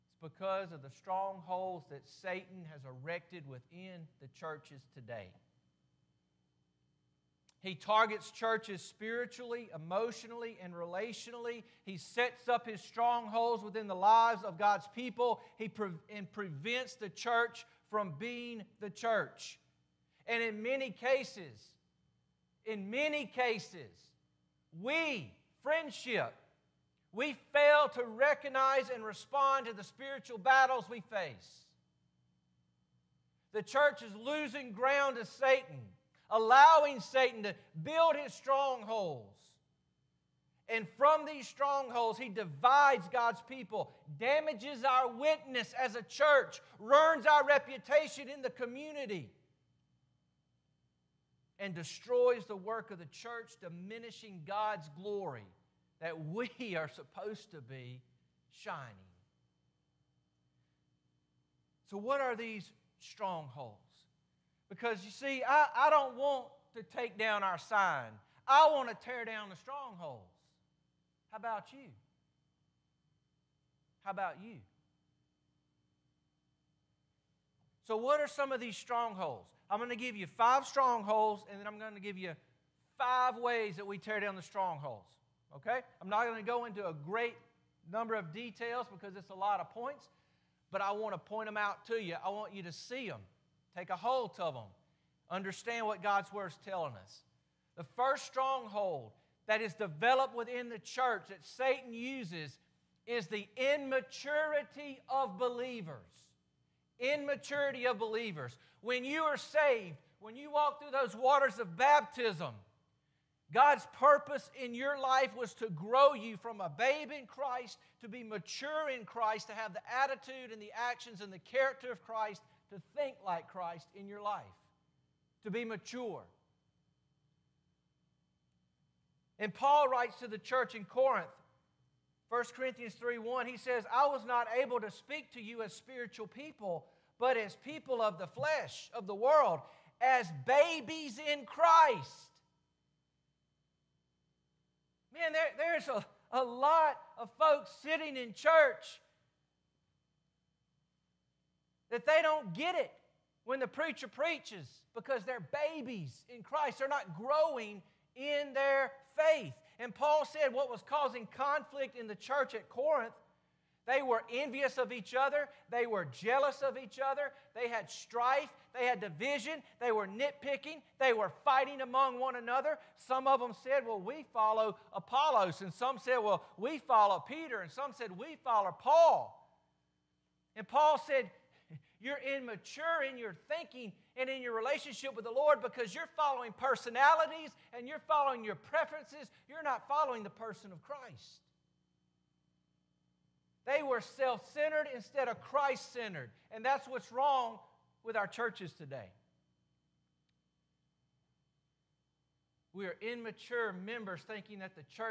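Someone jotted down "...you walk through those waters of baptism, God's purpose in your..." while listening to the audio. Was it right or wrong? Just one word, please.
right.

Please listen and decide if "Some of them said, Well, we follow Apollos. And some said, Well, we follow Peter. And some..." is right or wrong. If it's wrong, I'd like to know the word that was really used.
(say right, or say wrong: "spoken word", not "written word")
right.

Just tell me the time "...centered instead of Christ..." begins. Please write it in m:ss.
3:14.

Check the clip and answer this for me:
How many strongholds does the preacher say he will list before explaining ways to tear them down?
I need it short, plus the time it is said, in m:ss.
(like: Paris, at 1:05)
5, at 1:20.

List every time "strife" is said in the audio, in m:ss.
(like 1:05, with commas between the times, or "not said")
2:47.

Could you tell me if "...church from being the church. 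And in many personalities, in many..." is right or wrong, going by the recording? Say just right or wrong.
wrong.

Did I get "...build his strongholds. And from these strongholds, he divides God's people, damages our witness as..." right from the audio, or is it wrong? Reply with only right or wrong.
right.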